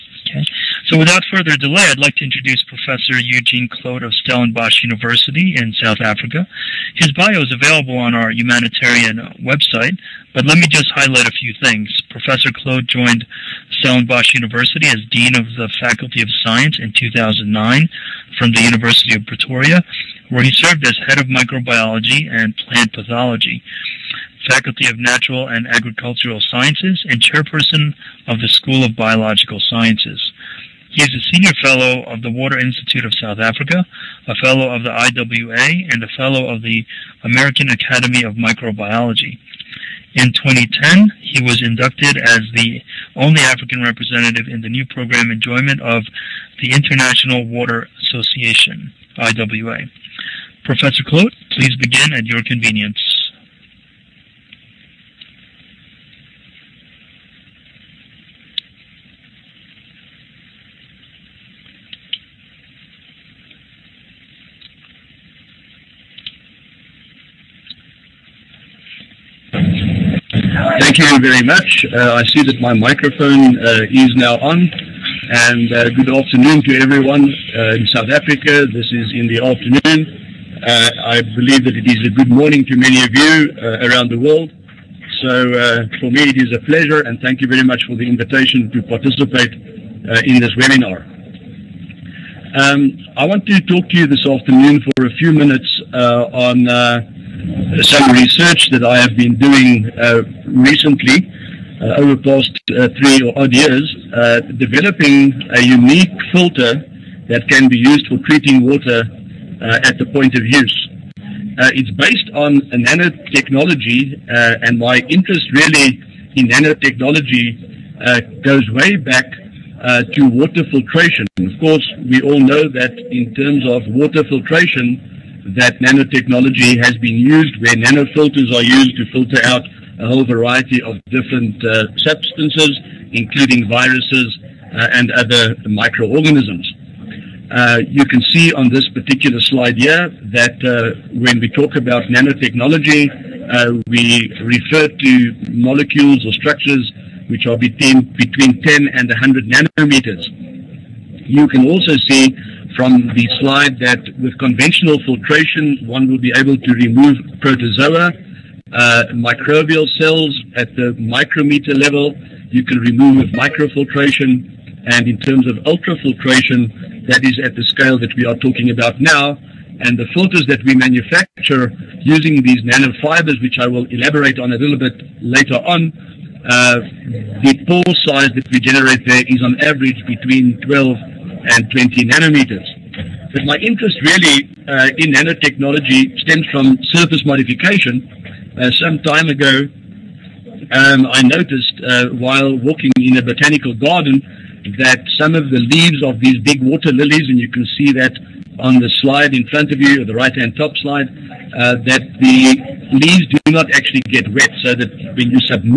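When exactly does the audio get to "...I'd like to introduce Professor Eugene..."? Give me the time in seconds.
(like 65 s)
1 s.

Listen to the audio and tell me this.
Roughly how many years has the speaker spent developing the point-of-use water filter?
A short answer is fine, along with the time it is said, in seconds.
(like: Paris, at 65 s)
3, at 103 s.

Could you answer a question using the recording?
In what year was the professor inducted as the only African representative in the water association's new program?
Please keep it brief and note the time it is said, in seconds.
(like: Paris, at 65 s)
2010, at 40 s.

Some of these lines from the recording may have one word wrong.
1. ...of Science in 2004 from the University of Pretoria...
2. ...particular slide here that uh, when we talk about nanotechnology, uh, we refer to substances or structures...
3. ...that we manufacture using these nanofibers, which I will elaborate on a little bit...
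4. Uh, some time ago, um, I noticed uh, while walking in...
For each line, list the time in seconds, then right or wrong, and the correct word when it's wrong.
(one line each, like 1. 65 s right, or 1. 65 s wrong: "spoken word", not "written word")
1. 16 s wrong: "2009", not "2004"
2. 138 s wrong: "molecules", not "substances"
3. 170 s right
4. 188 s right.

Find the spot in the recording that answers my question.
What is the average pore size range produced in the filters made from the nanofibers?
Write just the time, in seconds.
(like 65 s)
180 s.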